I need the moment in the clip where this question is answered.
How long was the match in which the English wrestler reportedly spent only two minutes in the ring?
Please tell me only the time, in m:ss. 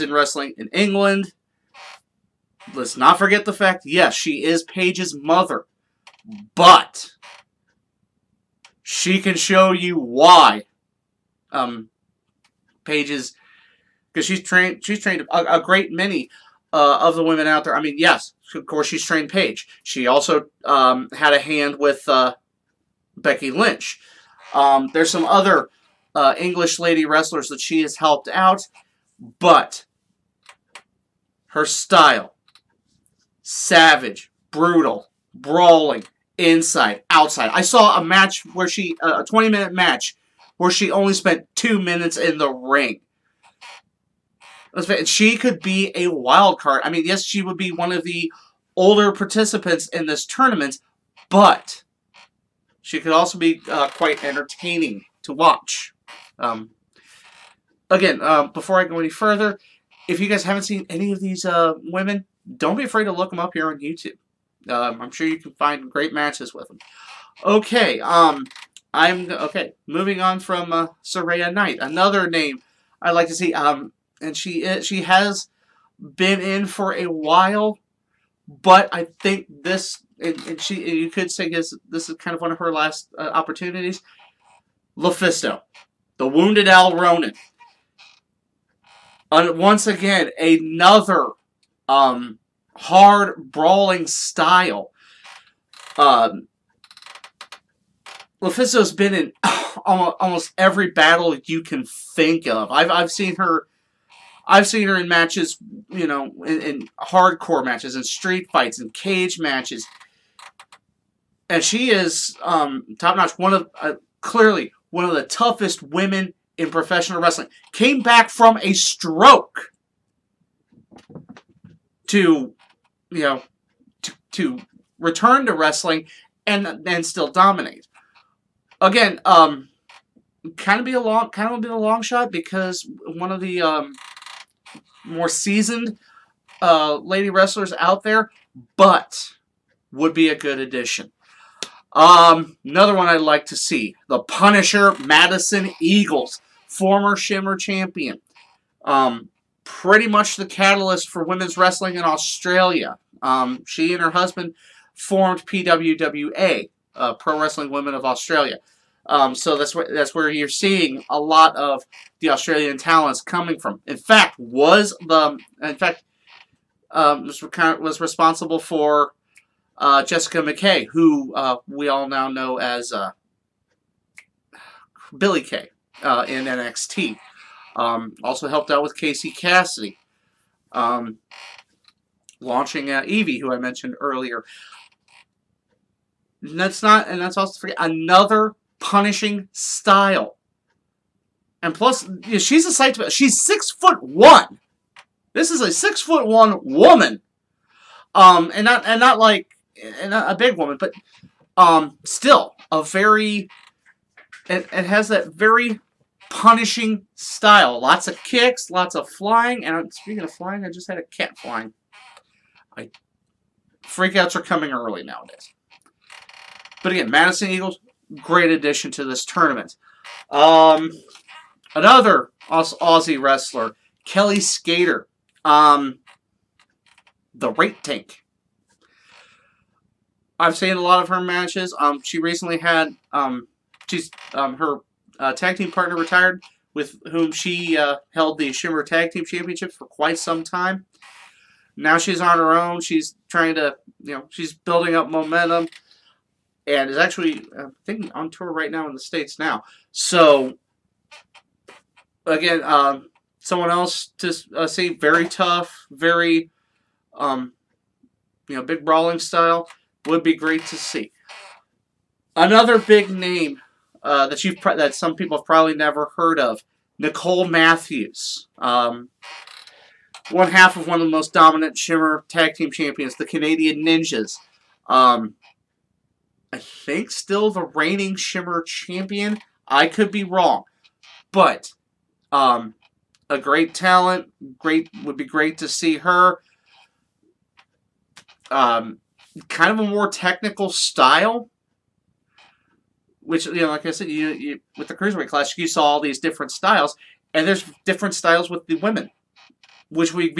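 0:39.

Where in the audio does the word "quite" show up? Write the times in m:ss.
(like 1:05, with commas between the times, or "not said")
0:53, 3:59.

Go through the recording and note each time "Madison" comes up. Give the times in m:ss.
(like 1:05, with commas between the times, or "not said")
2:24, 3:37.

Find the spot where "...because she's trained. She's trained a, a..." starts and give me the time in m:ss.
0:14.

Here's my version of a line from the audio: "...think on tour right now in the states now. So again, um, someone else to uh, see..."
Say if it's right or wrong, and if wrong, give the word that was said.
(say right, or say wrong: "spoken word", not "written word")
right.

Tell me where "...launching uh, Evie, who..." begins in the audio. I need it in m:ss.
3:02.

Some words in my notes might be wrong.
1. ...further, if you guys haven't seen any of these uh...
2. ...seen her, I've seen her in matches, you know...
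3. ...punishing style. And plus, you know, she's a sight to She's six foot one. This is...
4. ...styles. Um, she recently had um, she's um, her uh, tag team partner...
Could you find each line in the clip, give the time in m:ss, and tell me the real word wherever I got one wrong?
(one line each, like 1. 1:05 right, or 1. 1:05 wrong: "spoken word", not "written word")
1. 0:59 right
2. 1:43 right
3. 3:08 right
4. 3:51 wrong: "matches", not "styles".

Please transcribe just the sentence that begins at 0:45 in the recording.
She could be a wild card.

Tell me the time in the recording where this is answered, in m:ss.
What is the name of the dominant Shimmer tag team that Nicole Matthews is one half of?
4:33.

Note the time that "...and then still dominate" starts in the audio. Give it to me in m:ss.
2:06.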